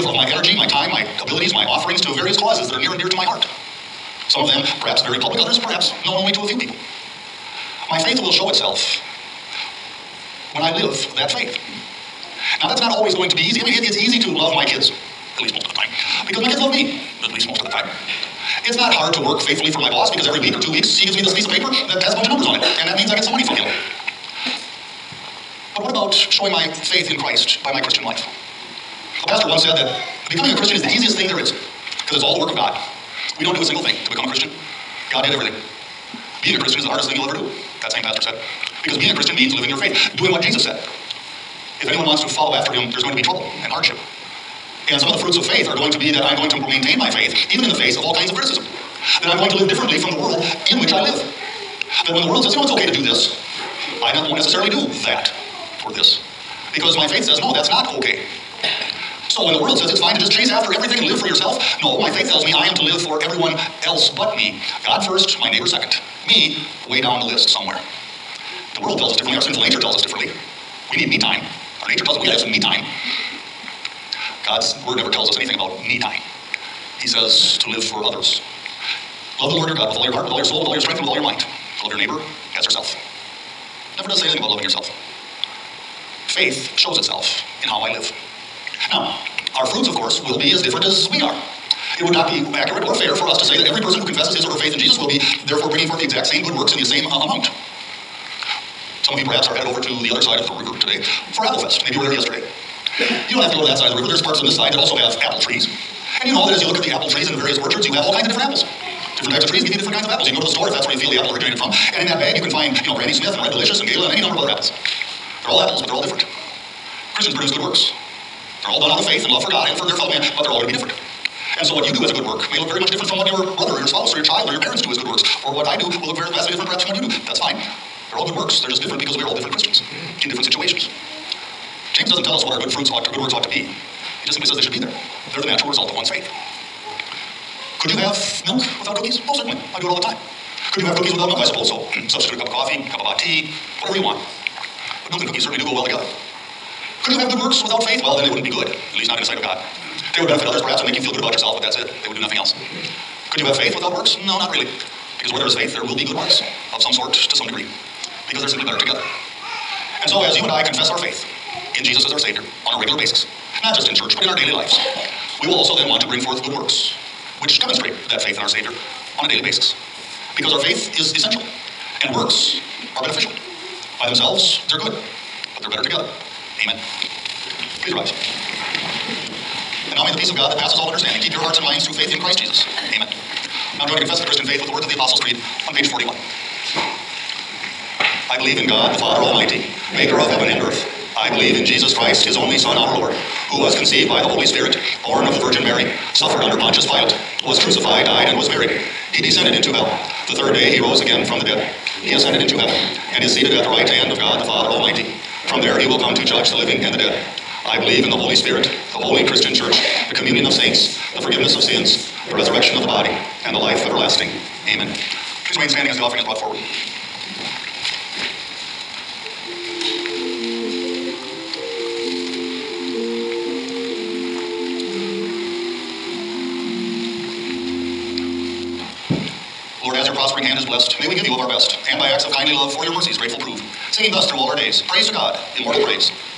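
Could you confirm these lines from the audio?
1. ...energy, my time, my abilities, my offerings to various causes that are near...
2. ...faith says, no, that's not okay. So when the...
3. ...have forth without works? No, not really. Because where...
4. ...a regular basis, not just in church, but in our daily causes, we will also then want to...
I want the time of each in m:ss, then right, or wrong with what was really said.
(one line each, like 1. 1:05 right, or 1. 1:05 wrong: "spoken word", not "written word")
1. 0:00 right
2. 0:57 right
3. 2:33 wrong: "faith", not "forth"
4. 2:42 wrong: "lives", not "causes".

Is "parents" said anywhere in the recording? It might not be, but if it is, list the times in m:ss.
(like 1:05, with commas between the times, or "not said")
2:04.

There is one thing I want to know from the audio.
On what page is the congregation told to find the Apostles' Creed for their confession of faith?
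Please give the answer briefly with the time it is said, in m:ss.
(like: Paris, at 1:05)
41, at 3:05.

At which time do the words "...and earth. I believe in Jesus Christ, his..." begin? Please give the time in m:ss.
3:10.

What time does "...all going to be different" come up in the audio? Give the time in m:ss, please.
2:00.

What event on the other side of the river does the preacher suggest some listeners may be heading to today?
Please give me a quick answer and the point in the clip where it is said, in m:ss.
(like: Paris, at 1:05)
Applefest, at 1:41.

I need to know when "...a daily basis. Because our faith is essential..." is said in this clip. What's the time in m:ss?
2:49.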